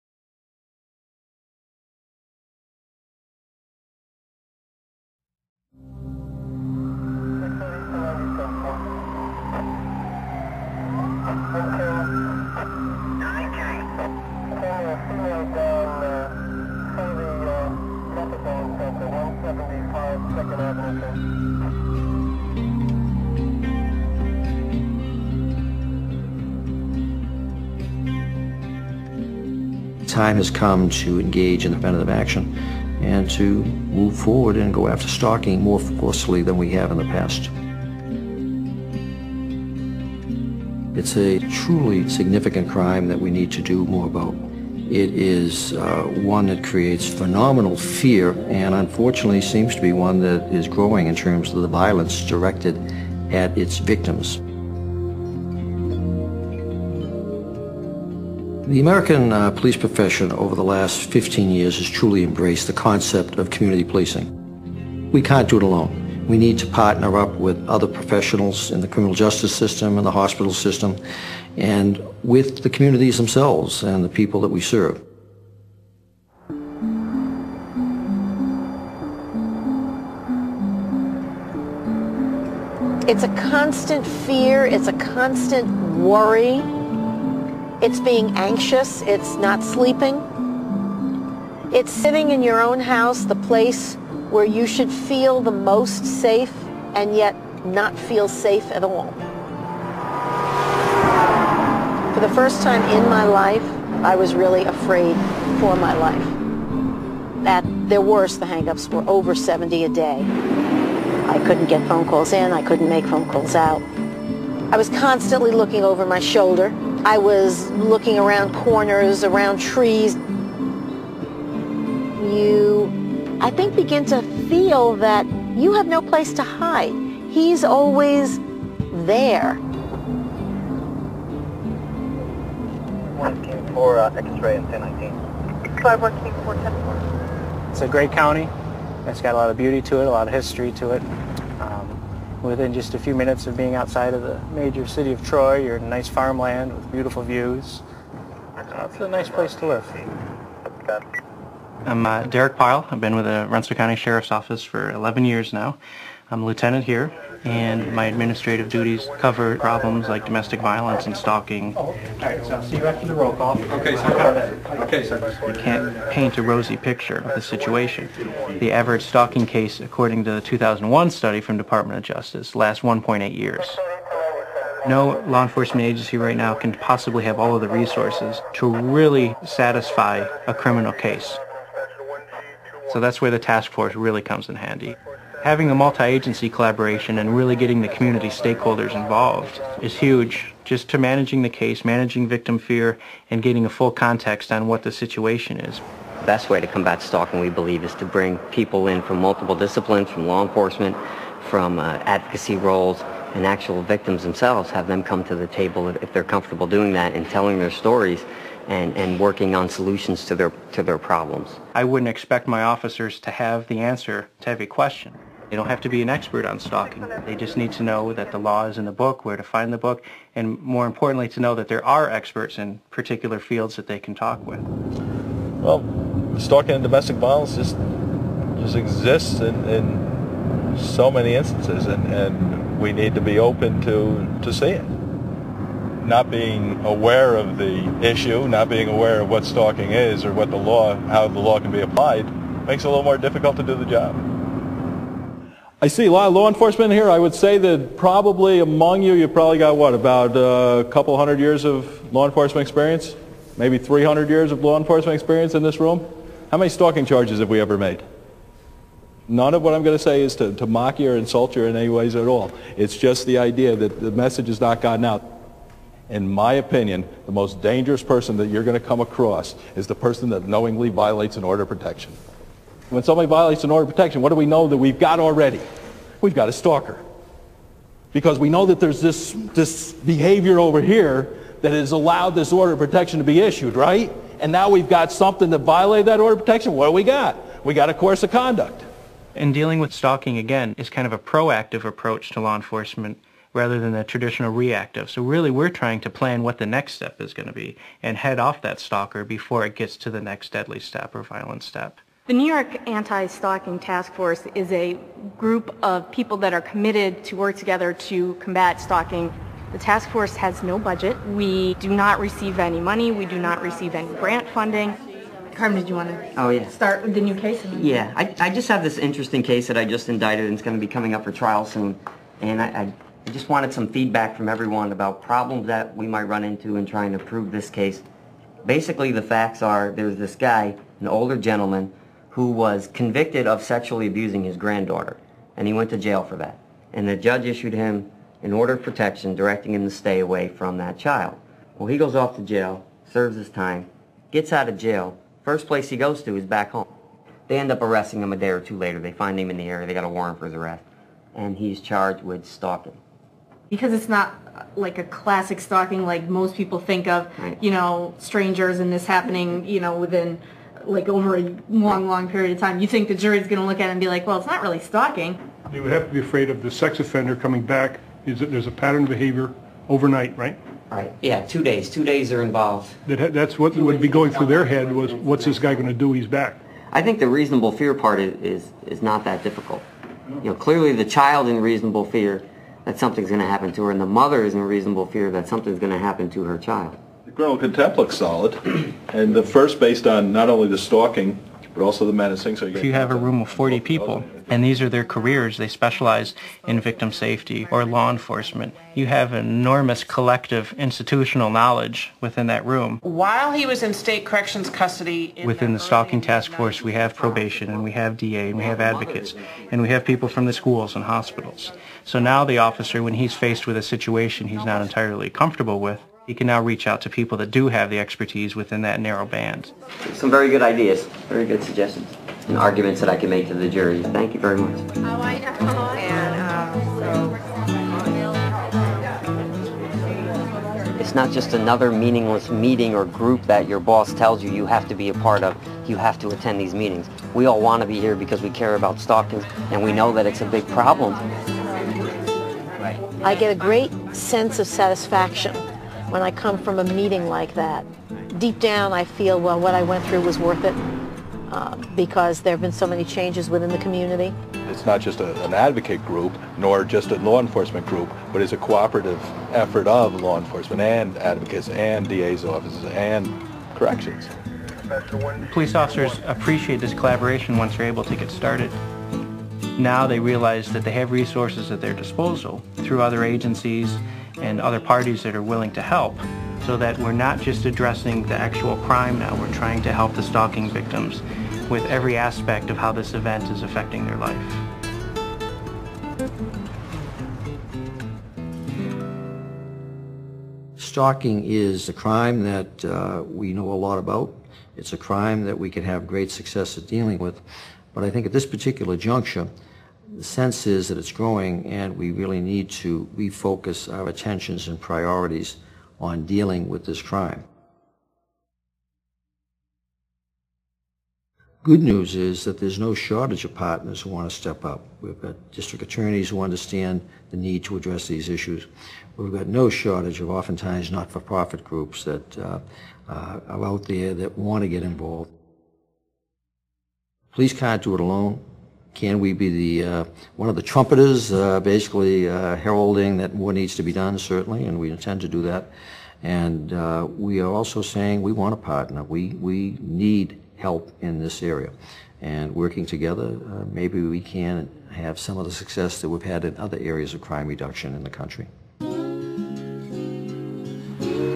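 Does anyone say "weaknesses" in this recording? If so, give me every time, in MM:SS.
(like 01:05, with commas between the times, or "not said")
not said.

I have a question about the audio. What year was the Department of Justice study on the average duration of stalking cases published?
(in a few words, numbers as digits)
2001.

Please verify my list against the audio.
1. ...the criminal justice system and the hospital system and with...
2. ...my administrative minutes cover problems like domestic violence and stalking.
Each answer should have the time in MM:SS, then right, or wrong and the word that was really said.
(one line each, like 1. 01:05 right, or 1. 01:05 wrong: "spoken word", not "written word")
1. 01:08 right
2. 02:37 wrong: "duties", not "minutes".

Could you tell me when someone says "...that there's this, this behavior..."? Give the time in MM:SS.
04:38.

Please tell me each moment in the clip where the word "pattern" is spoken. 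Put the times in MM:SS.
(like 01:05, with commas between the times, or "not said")
06:08.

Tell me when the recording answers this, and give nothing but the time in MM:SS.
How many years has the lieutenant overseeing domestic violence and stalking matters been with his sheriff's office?
02:34.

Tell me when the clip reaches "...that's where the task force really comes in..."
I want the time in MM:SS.
03:02.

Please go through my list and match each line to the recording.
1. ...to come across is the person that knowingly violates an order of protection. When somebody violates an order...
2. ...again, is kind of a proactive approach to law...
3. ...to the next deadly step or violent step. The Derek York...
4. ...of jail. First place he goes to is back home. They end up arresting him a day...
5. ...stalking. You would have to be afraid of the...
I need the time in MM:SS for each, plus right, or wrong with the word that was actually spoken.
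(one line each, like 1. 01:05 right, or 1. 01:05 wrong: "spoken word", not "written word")
1. 04:28 right
2. 04:50 right
3. 04:59 wrong: "New", not "Derek"
4. 05:44 right
5. 06:04 right.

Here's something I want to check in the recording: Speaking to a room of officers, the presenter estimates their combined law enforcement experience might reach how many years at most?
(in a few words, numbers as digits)
300 years.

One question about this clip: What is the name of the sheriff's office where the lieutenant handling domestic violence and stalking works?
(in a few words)
Rensselaer County Sheriff's Office.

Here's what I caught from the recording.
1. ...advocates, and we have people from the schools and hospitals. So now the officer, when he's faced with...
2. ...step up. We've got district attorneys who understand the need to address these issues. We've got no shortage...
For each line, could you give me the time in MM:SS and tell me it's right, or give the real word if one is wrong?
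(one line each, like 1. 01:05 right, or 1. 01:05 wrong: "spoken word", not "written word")
1. 06:48 right
2. 08:34 right.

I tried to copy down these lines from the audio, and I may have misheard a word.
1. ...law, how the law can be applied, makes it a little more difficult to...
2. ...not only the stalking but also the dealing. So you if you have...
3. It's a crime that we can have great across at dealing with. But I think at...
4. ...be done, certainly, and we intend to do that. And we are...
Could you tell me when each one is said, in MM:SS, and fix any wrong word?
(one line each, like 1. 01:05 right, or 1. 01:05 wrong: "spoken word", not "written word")
1. 04:00 right
2. 06:30 wrong: "menacing", not "dealing"
3. 08:14 wrong: "success", not "across"
4. 08:53 right.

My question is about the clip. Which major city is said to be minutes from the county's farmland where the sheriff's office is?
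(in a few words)
Troy.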